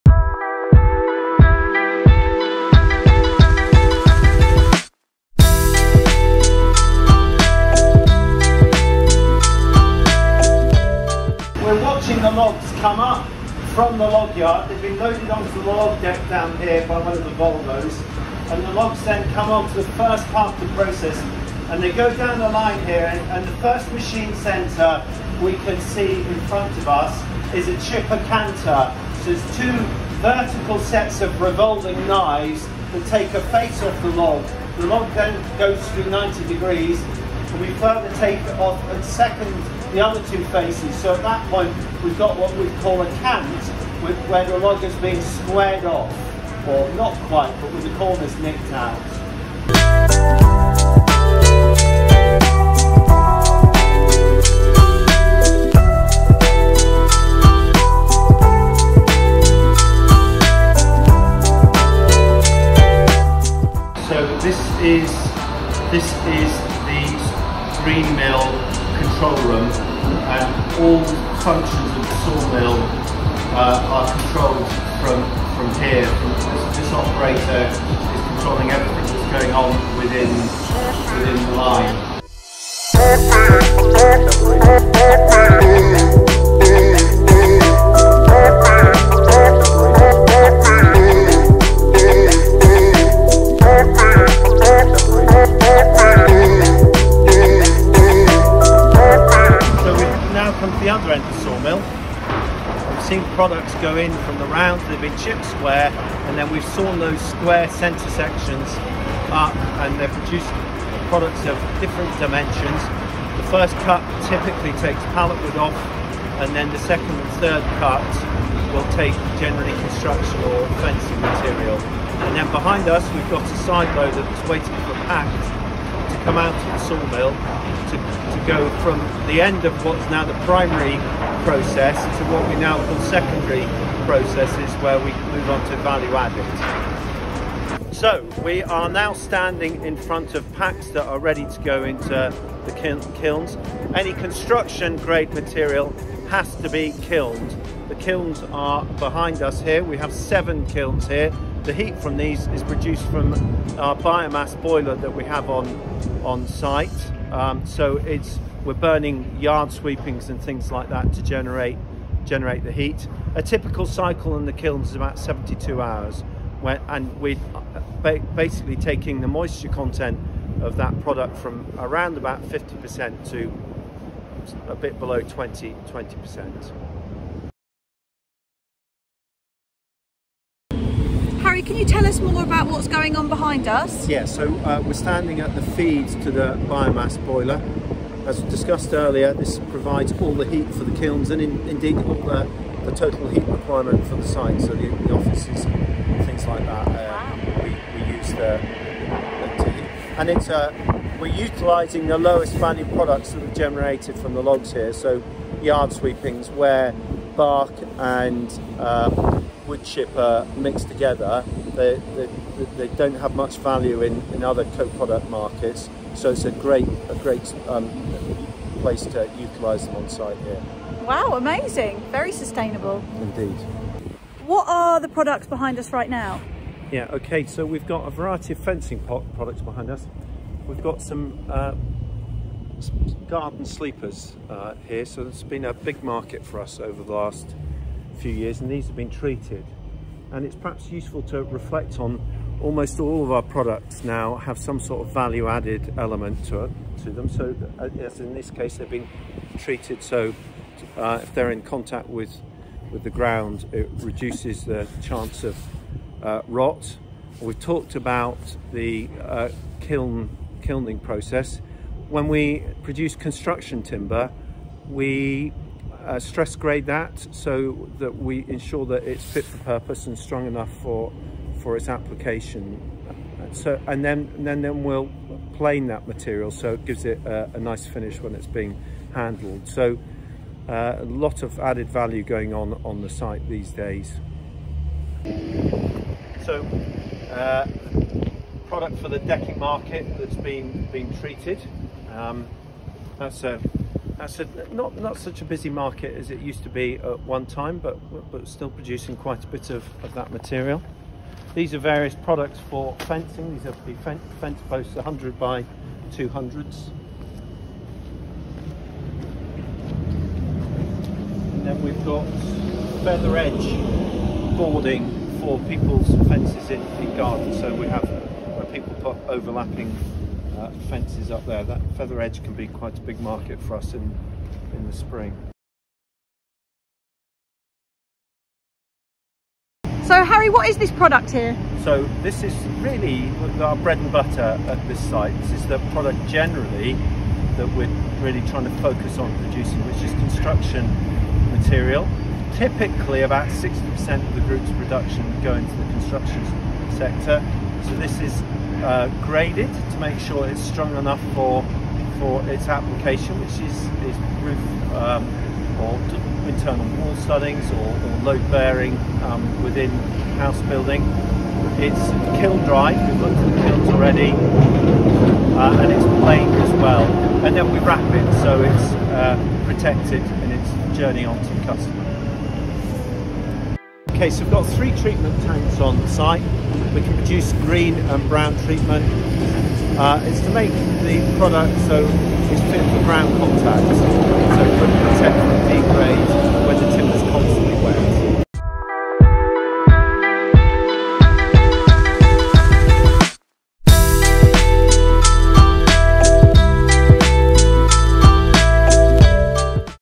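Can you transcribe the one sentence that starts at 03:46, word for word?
Yeah, okay, so we've got a variety of fencing products behind us.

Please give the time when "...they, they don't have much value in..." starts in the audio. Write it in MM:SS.
03:32.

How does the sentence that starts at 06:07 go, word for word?
And then we wrap it so it's uh, protected in its journey onto the customer.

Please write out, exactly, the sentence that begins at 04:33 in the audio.
So and then and then then we'll plane that material so it gives it a, a nice finish when it's being handled.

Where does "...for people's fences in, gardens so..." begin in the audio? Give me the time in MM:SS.
05:15.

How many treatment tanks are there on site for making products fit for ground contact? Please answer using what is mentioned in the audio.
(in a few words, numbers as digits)
3.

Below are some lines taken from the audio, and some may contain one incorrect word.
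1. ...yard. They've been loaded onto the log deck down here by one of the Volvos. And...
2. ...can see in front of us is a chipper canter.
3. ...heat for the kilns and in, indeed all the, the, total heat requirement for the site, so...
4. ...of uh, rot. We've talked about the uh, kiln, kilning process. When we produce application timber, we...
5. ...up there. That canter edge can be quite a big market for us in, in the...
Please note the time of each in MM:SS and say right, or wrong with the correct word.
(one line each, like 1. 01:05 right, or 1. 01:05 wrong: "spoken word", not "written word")
1. 00:14 right
2. 00:25 right
3. 03:10 right
4. 04:15 wrong: "construction", not "application"
5. 05:21 wrong: "feather", not "canter".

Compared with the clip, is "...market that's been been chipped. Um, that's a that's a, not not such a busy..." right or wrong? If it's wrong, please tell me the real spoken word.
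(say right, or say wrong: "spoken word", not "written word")
wrong: "treated", not "chipped".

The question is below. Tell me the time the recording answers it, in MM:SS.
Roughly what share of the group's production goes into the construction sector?
05:43.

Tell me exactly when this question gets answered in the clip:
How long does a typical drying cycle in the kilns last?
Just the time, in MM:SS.
02:45.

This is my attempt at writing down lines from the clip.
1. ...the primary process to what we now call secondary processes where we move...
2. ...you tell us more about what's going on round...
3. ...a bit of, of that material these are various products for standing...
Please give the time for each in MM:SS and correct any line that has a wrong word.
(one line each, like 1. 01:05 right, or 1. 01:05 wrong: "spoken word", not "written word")
1. 02:10 right
2. 03:01 wrong: "behind", not "round"
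3. 04:59 wrong: "fencing", not "standing".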